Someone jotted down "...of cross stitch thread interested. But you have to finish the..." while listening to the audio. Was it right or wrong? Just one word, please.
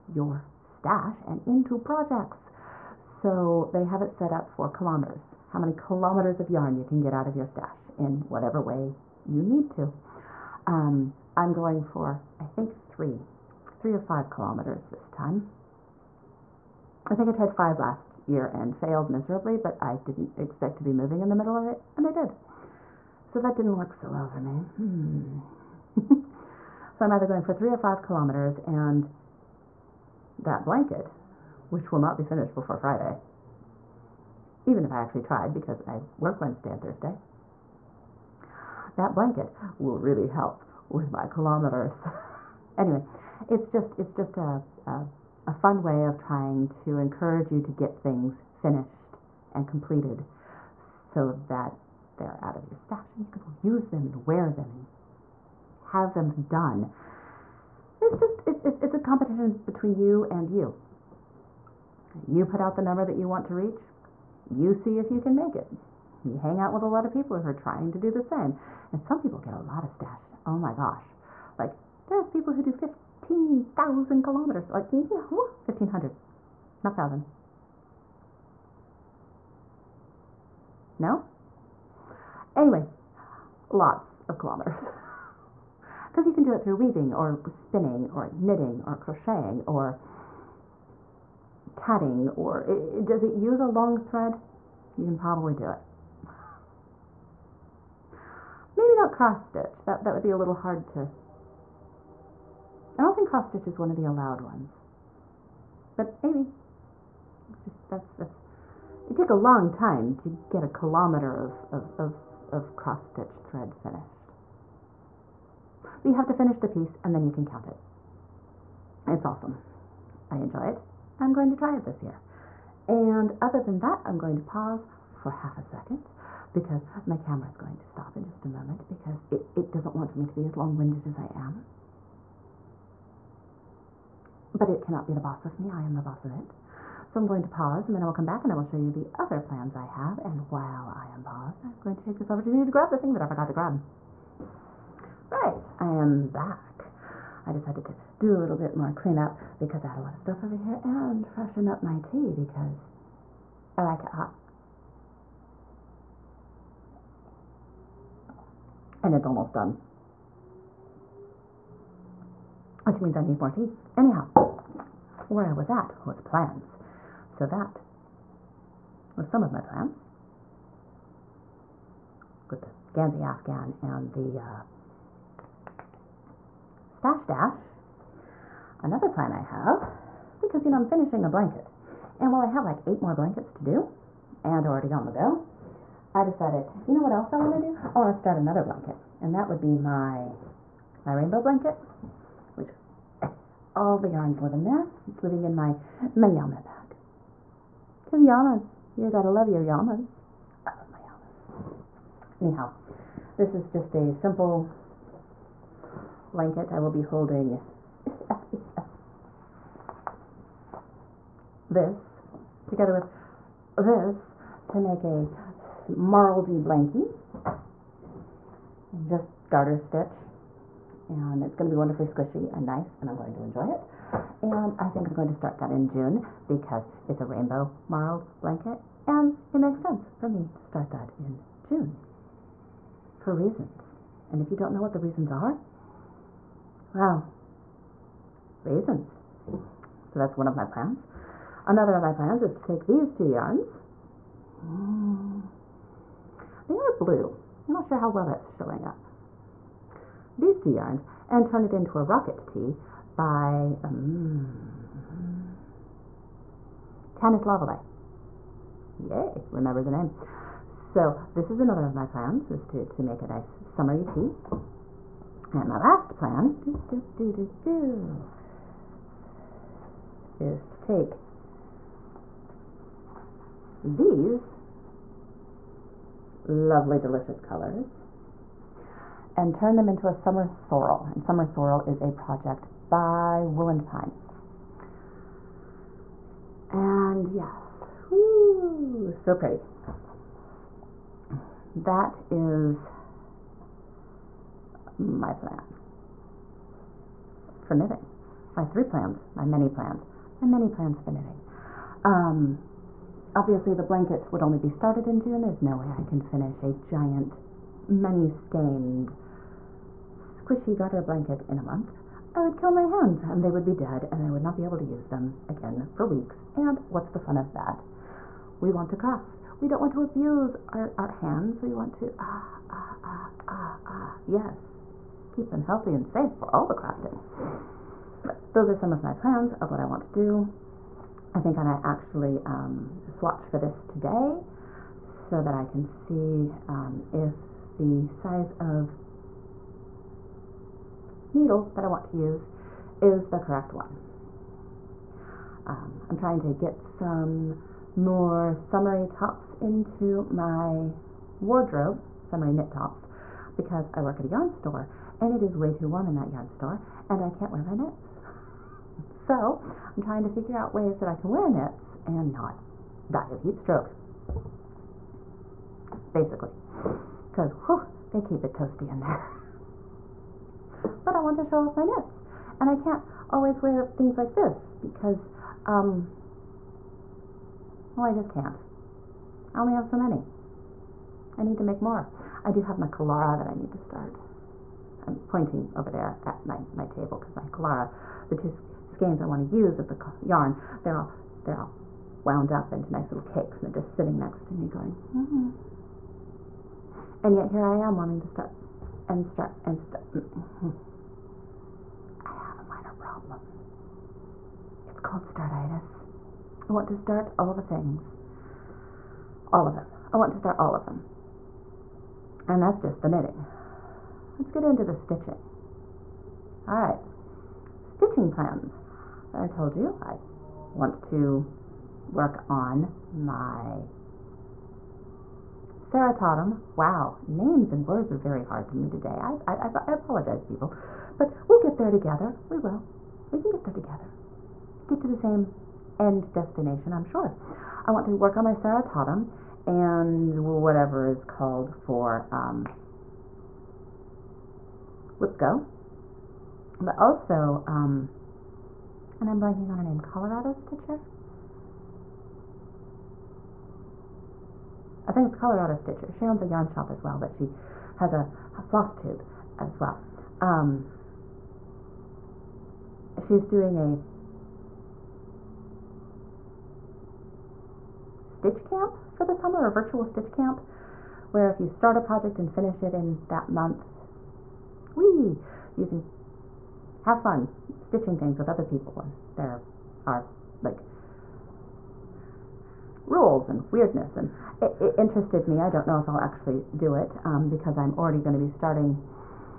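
wrong.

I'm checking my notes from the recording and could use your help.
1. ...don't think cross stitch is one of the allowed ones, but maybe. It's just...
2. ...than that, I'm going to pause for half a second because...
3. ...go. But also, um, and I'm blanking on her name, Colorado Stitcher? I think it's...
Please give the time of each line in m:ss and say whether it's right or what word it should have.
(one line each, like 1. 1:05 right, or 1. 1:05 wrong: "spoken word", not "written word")
1. 1:43 right
2. 2:03 right
3. 7:25 right.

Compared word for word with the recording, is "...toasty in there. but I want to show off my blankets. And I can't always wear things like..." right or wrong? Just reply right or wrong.
wrong.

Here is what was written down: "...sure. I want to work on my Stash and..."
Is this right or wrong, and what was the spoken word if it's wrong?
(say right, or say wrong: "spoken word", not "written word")
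wrong: "Ceratotum", not "Stash".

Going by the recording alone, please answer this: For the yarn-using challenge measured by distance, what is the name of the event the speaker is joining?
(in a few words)
Stash Dash.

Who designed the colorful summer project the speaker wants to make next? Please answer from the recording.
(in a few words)
Wooland Pine.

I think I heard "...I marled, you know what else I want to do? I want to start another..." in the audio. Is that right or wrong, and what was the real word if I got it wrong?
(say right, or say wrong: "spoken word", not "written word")
wrong: "decided", not "marled".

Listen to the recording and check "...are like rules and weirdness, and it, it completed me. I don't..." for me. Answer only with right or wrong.
wrong.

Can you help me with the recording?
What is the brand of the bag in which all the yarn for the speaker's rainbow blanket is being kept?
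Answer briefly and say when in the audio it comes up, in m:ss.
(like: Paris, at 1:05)
Yama, at 3:16.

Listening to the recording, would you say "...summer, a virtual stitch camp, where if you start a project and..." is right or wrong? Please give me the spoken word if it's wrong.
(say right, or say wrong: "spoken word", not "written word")
right.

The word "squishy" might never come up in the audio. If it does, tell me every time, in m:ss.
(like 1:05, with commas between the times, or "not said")
3:42, 5:10.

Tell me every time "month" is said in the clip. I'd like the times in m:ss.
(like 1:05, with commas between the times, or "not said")
5:11, 7:53.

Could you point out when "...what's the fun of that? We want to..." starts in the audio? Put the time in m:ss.
5:16.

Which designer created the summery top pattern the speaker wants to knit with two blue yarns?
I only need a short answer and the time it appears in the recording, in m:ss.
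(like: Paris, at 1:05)
Tanis Lavallee, at 4:17.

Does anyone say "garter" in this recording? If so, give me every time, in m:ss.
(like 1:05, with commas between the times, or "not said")
3:39, 5:10.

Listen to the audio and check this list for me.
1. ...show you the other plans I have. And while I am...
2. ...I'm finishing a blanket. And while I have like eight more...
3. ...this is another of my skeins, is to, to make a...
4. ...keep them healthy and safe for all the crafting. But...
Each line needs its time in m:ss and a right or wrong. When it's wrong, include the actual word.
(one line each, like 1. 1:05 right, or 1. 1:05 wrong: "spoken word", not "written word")
1. 2:18 right
2. 3:00 right
3. 4:21 wrong: "plans", not "skeins"
4. 5:25 right.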